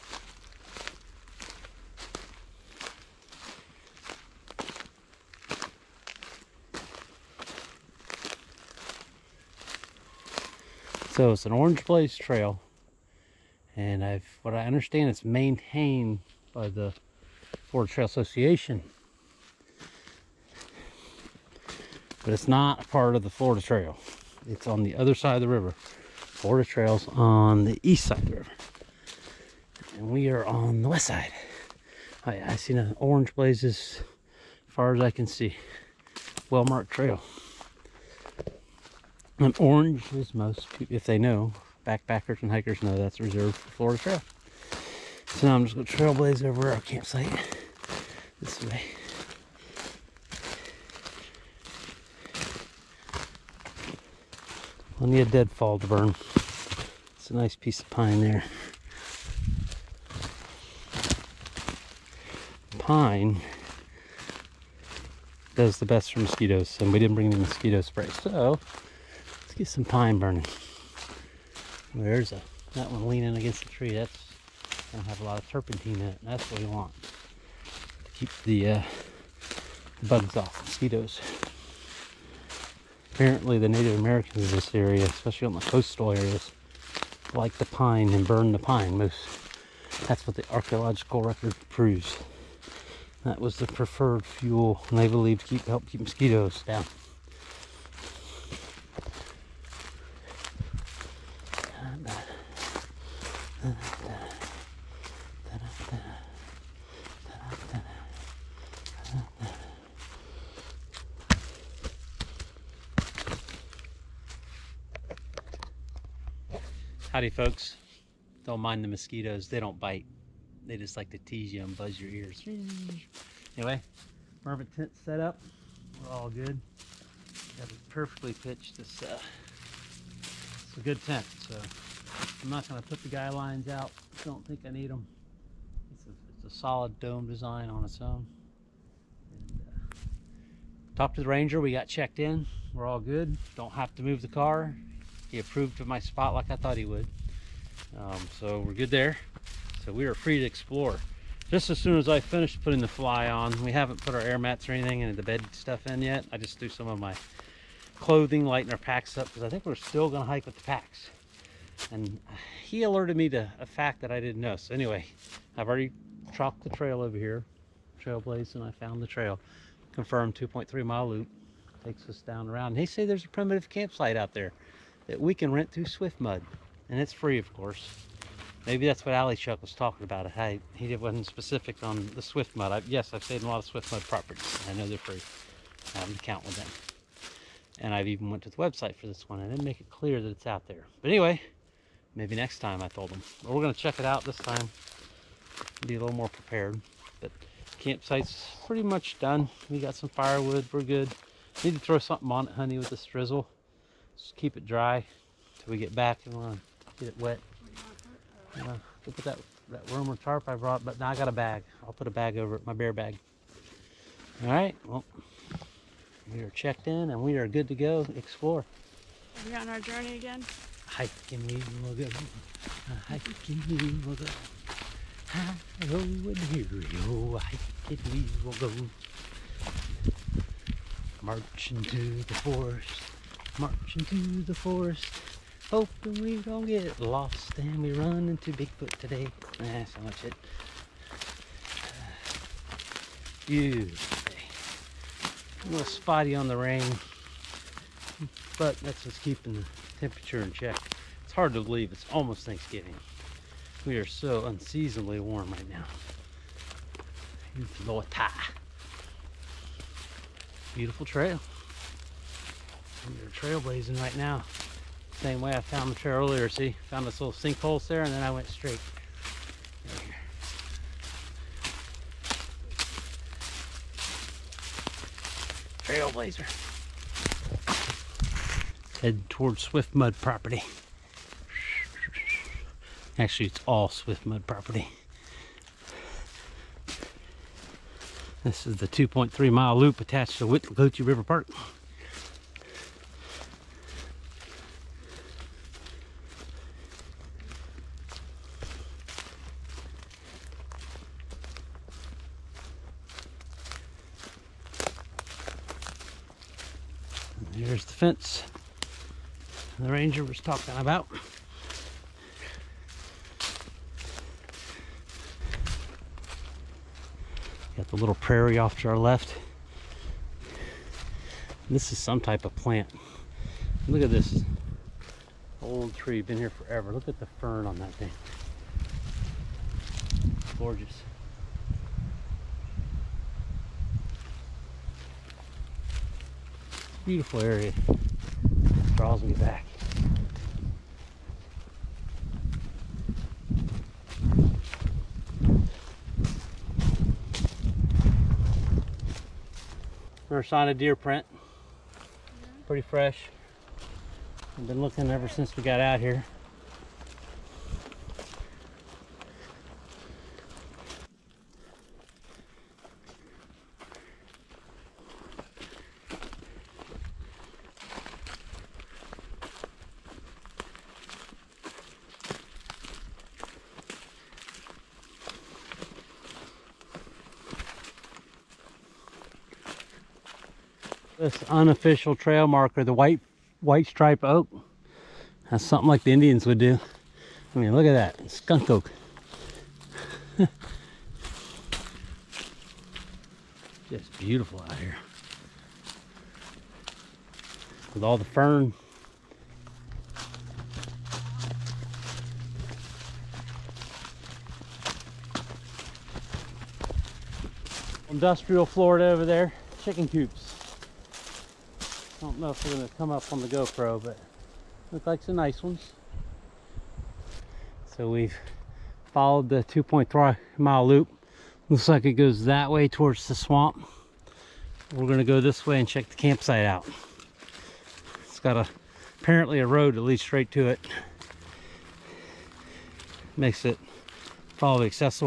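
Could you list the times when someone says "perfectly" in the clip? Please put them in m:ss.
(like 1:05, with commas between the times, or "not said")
2:07.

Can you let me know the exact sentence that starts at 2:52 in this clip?
They say there's a primitive campsite out there that we can rent through Swift Mud, and it's free, of course.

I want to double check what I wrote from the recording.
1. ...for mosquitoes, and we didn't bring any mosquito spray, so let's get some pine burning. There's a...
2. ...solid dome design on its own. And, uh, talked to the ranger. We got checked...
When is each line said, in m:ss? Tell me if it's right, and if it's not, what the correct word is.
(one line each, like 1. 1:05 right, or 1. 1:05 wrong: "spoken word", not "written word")
1. 1:06 right
2. 2:16 right.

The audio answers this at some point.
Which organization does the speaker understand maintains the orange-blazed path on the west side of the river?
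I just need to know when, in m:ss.
0:17.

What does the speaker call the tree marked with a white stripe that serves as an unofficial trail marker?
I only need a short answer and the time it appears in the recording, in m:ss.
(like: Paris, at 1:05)
Skunk oak, at 6:28.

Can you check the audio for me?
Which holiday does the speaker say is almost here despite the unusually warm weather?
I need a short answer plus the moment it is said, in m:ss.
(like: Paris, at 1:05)
Thanksgiving, at 4:12.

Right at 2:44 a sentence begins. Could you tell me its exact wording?
So anyway, I've already chalked the trail over here, trailblazed, and I found the trail.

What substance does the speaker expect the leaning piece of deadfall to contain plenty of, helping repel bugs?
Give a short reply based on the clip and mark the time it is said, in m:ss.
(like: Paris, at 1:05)
Turpentine, at 1:15.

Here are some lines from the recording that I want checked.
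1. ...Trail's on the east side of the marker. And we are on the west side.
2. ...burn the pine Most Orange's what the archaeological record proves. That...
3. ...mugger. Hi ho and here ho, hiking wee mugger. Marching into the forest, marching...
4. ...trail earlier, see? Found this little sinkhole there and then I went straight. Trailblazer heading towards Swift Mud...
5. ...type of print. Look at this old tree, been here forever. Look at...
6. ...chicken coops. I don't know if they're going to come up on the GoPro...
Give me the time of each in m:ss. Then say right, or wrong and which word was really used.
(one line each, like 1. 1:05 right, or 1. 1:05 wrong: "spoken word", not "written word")
1. 0:26 wrong: "river", not "marker"
2. 1:28 wrong: "That", not "Orange"
3. 3:44 right
4. 4:25 right
5. 5:22 wrong: "plant", not "print"
6. 6:49 right.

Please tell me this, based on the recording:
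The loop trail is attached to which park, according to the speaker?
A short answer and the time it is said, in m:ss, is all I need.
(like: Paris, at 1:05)
Withlacoochee River Park, at 4:50.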